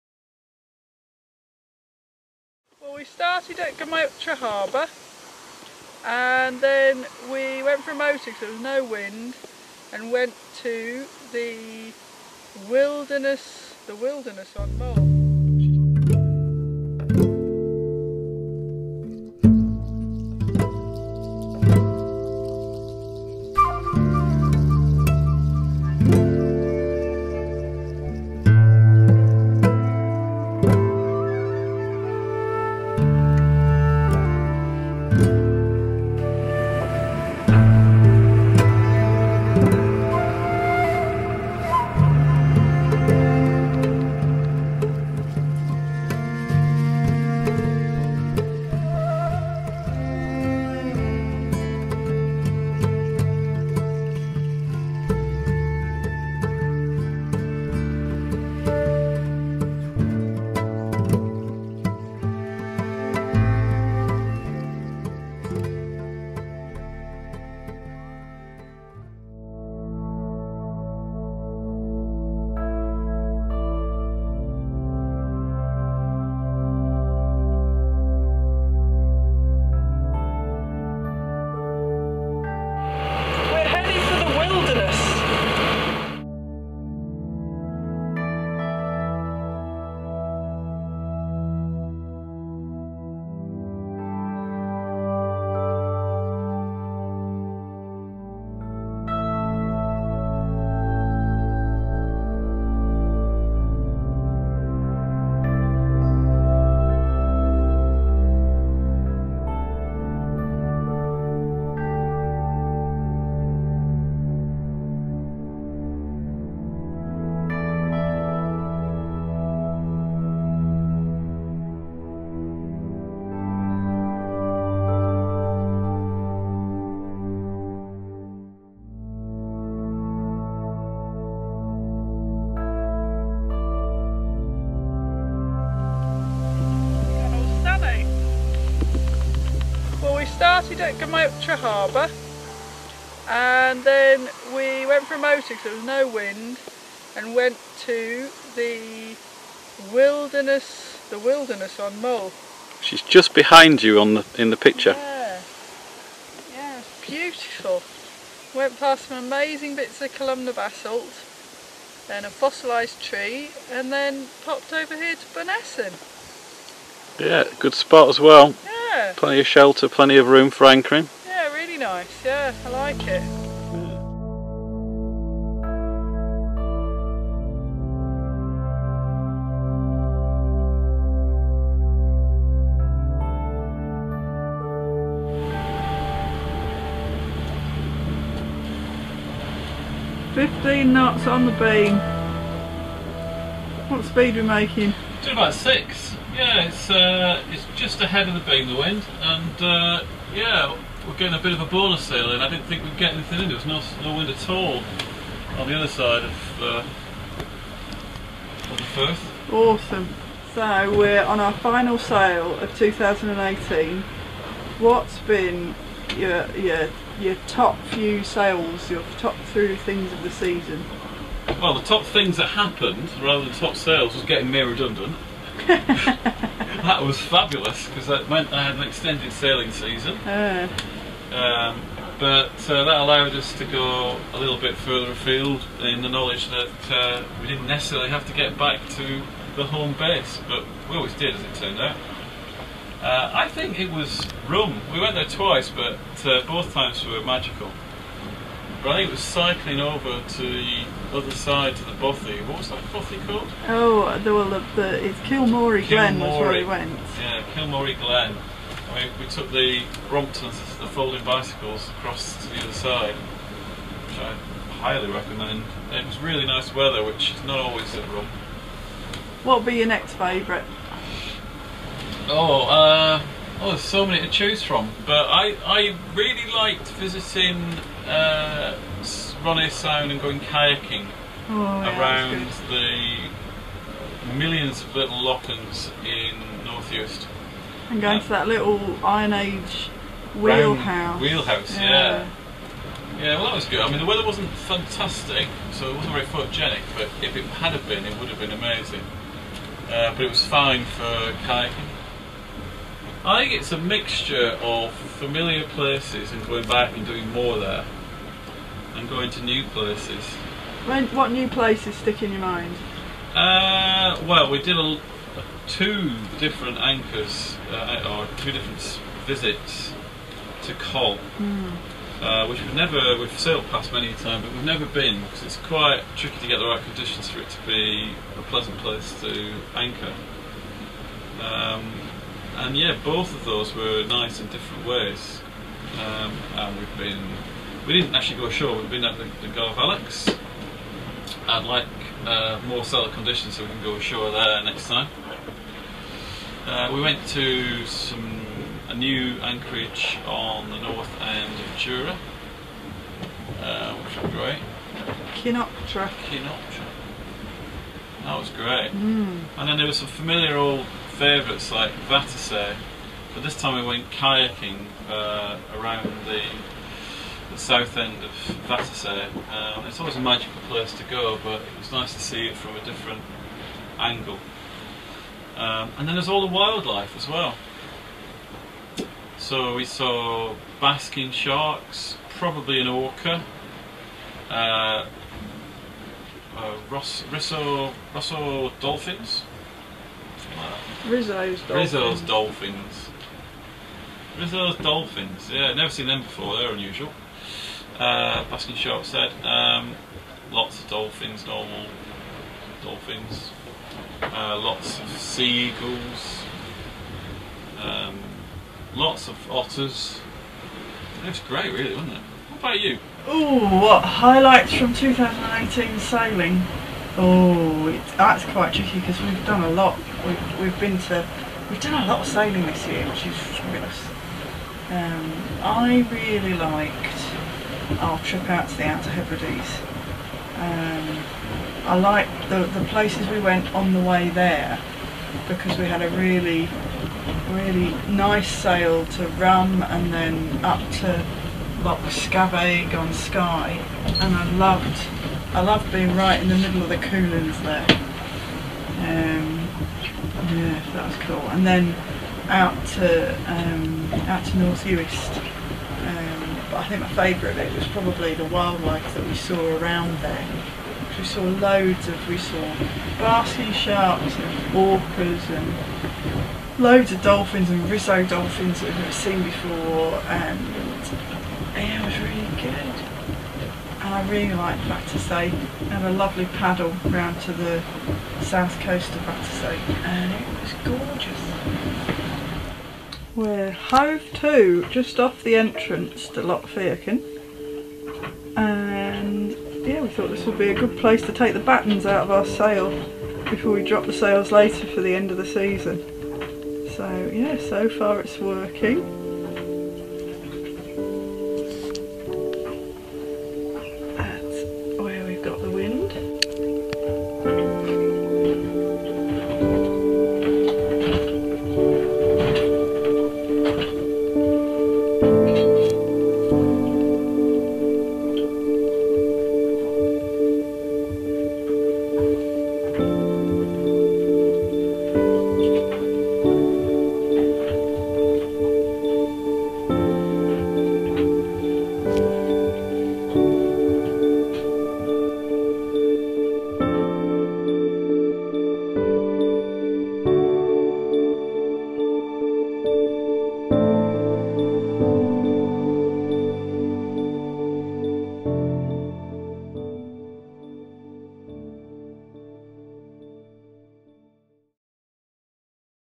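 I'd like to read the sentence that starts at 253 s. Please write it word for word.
Oh, well, were the, the it's Kilmory Glen was where we went.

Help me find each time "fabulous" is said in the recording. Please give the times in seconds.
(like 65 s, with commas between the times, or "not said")
227 s, 423 s.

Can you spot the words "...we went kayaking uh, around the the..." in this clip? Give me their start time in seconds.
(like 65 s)
363 s.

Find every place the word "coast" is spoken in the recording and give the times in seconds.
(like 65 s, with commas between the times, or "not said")
478 s.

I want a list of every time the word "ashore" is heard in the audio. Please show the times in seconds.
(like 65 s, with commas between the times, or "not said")
338 s, 343 s.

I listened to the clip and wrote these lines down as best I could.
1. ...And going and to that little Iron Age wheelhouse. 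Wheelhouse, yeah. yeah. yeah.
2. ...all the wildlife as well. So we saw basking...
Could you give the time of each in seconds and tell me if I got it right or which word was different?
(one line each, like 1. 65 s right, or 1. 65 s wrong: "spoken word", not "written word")
1. 287 s right
2. 376 s right.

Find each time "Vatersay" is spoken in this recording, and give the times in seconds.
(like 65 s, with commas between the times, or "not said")
362 s, 368 s, 474 s, 479 s.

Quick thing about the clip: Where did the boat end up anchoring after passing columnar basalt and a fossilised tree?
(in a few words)
Bunessan.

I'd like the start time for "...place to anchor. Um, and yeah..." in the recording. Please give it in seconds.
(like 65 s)
328 s.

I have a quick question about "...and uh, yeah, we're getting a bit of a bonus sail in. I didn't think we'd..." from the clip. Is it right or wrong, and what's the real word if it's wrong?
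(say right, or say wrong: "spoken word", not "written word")
right.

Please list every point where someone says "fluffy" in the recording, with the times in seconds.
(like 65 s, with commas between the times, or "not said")
not said.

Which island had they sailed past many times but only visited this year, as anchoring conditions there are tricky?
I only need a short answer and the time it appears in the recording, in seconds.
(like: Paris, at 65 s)
Coll, at 320 s.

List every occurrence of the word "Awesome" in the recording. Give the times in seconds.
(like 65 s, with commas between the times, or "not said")
209 s.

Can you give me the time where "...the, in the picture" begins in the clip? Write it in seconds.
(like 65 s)
154 s.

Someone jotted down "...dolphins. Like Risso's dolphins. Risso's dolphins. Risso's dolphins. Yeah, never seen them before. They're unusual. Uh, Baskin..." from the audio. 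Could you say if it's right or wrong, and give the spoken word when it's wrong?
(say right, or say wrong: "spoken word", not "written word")
right.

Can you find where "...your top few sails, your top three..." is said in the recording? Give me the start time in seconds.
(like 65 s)
217 s.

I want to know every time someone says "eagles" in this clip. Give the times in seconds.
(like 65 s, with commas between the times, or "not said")
405 s.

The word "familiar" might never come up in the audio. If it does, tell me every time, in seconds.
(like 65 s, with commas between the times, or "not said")
304 s, 360 s.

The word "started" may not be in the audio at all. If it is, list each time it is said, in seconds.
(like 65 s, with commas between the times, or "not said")
3 s, 140 s.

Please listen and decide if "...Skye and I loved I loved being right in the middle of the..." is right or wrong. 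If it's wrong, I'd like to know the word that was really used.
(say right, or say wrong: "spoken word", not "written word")
right.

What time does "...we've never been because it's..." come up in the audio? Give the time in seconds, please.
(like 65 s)
324 s.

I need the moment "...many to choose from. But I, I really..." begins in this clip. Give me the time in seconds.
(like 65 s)
274 s.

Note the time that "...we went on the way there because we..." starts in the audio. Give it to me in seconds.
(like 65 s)
433 s.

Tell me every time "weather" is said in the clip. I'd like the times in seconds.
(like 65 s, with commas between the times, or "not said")
266 s, 294 s.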